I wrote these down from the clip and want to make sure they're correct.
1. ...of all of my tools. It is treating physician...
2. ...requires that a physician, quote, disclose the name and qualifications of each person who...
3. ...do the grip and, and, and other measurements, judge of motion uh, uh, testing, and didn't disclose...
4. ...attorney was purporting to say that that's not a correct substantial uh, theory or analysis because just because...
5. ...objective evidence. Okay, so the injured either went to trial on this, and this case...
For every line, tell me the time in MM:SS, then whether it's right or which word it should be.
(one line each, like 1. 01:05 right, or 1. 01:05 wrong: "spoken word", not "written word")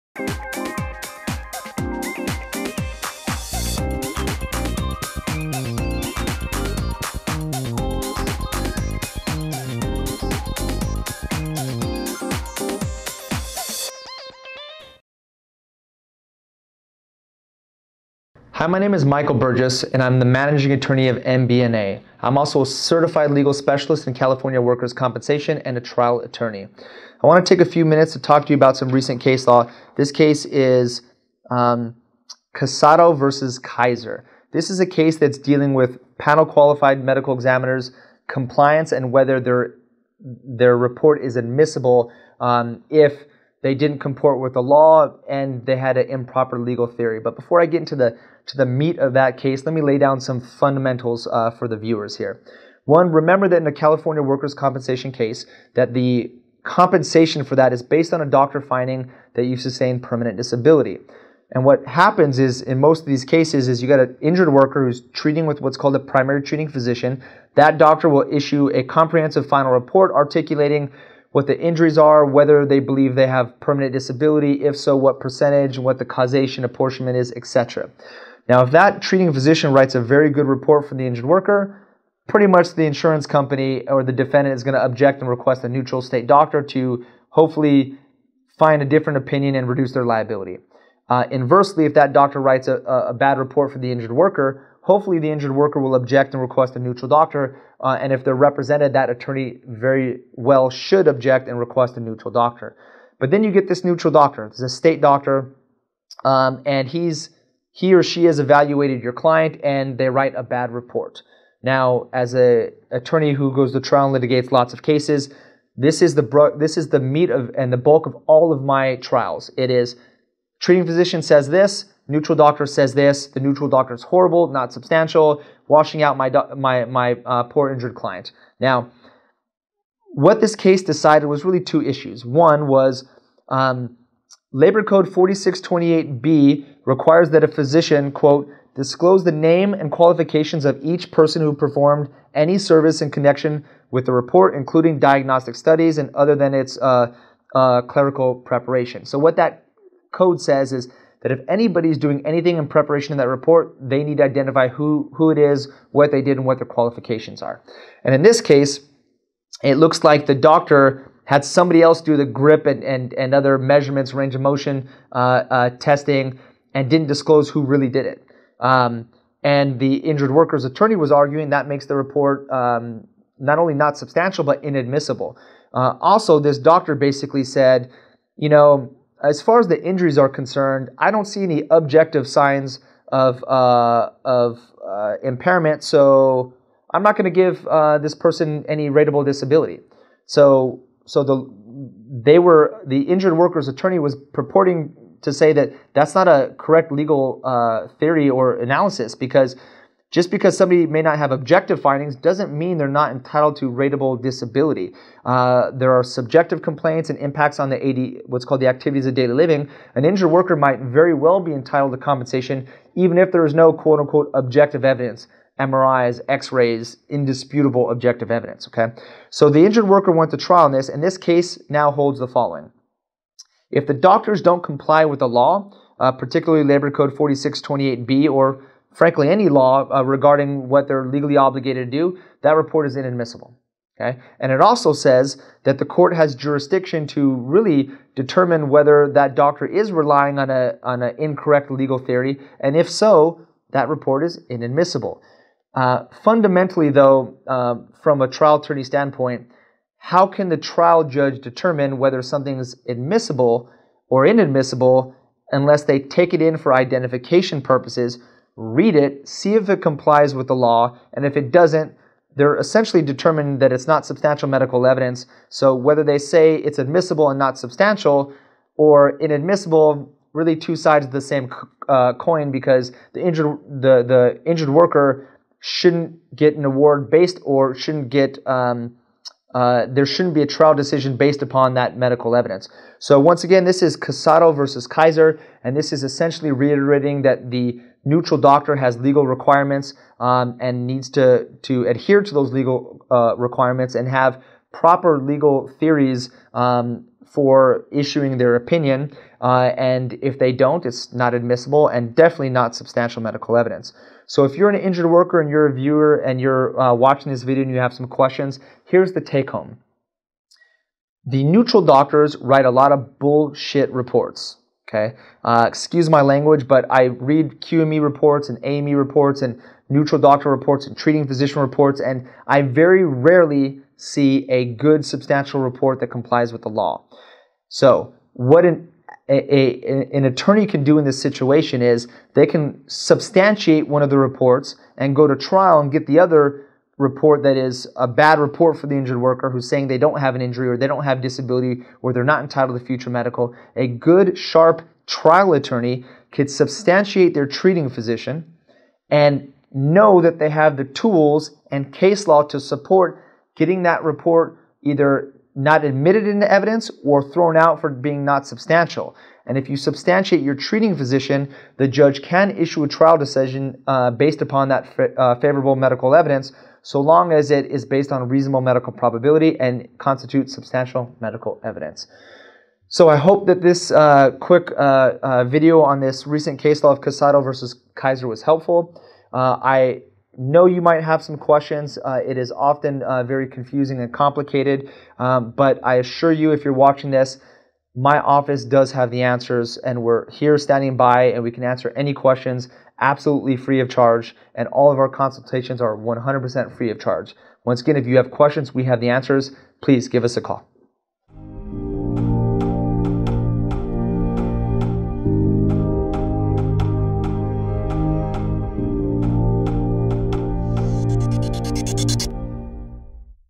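1. 01:58 wrong: "trials", not "tools"
2. 02:16 right
3. 02:42 wrong: "range", not "judge"
4. 03:13 wrong: "legal", not "substantial"
5. 03:37 wrong: "worker", not "either".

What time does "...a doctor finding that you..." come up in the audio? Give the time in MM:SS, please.
00:58.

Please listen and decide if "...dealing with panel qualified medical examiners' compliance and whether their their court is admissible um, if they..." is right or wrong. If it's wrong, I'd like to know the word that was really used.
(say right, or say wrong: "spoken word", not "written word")
wrong: "report", not "court".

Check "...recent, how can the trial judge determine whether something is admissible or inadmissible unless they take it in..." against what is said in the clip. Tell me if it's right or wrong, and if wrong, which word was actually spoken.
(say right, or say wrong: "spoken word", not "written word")
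wrong: "standpoint", not "recent".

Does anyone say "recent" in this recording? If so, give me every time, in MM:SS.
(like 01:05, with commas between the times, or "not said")
00:28, 06:16.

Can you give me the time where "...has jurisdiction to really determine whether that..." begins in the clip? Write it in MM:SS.
03:56.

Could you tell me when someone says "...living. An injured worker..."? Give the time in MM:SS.
03:29.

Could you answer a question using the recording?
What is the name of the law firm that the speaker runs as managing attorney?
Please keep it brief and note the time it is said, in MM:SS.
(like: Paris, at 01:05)
MB&A, at 00:21.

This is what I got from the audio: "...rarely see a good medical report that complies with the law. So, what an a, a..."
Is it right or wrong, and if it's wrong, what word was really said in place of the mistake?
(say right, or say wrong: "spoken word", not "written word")
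wrong: "substantial", not "medical".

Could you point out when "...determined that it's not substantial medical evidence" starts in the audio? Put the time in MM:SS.
04:23.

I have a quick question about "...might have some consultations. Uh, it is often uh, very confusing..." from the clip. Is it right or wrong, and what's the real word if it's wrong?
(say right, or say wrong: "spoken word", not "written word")
wrong: "questions", not "consultations".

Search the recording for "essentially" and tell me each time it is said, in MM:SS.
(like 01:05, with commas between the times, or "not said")
04:22, 04:46.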